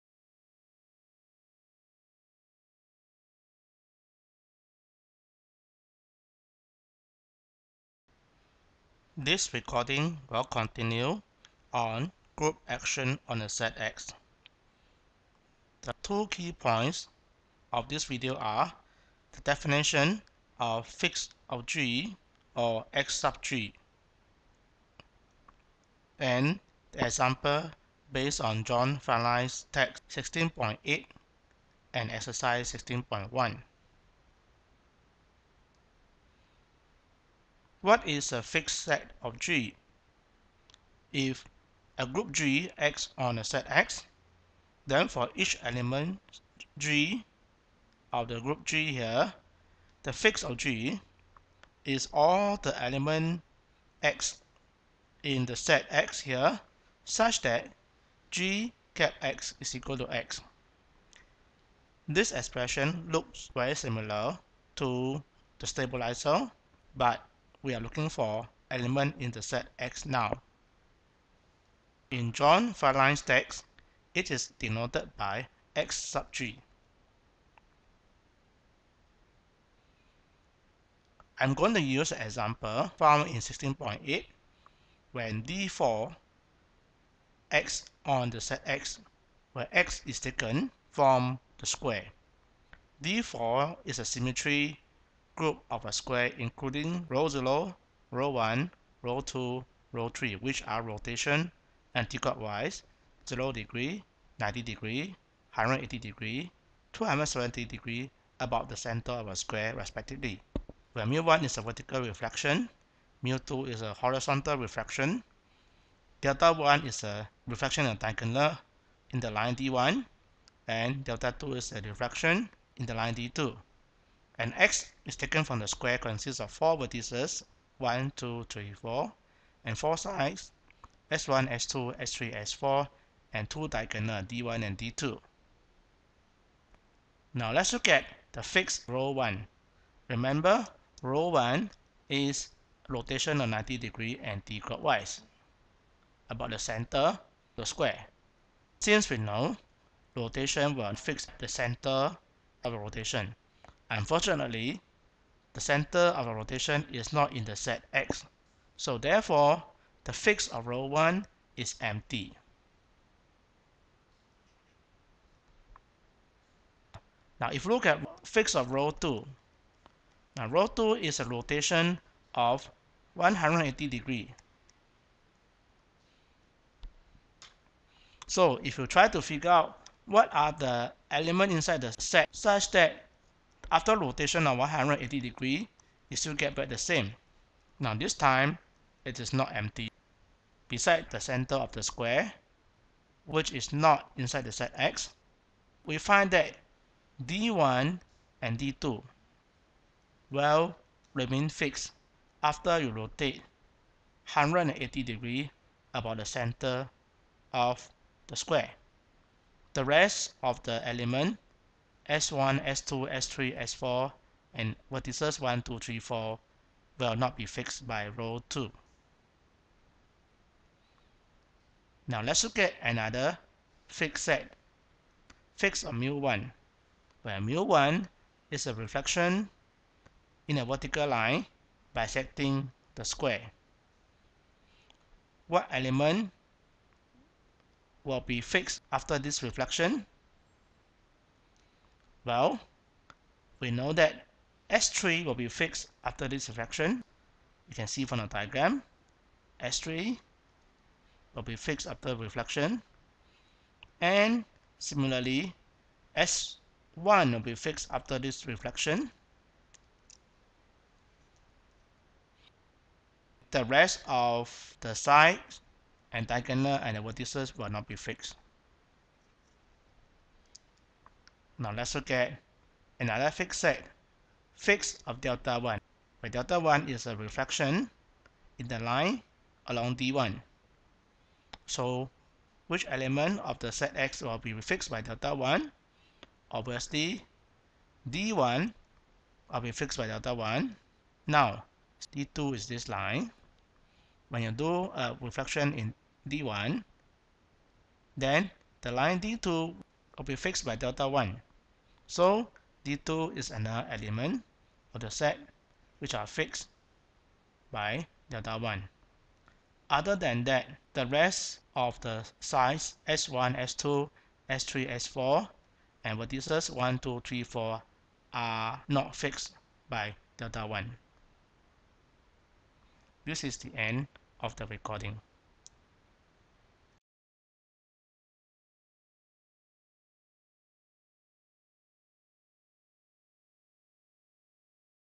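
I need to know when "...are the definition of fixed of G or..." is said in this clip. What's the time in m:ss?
0:18.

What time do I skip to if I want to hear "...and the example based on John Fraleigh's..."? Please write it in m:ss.
0:26.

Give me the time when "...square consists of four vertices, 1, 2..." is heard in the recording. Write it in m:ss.
2:05.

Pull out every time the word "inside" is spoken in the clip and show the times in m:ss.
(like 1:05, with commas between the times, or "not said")
3:01, 3:14.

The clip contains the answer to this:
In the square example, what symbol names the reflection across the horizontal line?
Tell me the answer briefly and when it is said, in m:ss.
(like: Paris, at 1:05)
mu 2, at 1:53.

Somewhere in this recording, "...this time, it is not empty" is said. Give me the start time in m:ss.
3:07.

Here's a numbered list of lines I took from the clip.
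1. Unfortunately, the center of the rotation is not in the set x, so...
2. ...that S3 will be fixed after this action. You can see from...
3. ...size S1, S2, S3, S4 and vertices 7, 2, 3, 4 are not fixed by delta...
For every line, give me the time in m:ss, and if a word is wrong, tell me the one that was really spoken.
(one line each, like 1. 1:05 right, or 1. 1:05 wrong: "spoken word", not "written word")
1. 2:33 right
2. 4:03 wrong: "reflection", not "action"
3. 5:12 wrong: "1", not "7".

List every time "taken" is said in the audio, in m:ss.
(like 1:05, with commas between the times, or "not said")
1:30, 2:05.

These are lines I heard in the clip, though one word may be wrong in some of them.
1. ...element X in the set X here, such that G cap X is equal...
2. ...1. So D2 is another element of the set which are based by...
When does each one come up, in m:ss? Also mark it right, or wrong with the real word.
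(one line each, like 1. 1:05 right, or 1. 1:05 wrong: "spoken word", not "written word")
1. 0:52 right
2. 5:01 wrong: "fixed", not "based".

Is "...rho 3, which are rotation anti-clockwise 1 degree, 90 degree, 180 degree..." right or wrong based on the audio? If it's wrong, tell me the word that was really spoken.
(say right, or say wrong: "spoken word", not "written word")
wrong: "0", not "1".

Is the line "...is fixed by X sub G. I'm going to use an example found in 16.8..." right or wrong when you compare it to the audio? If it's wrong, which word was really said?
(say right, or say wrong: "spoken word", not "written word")
wrong: "denoted", not "fixed".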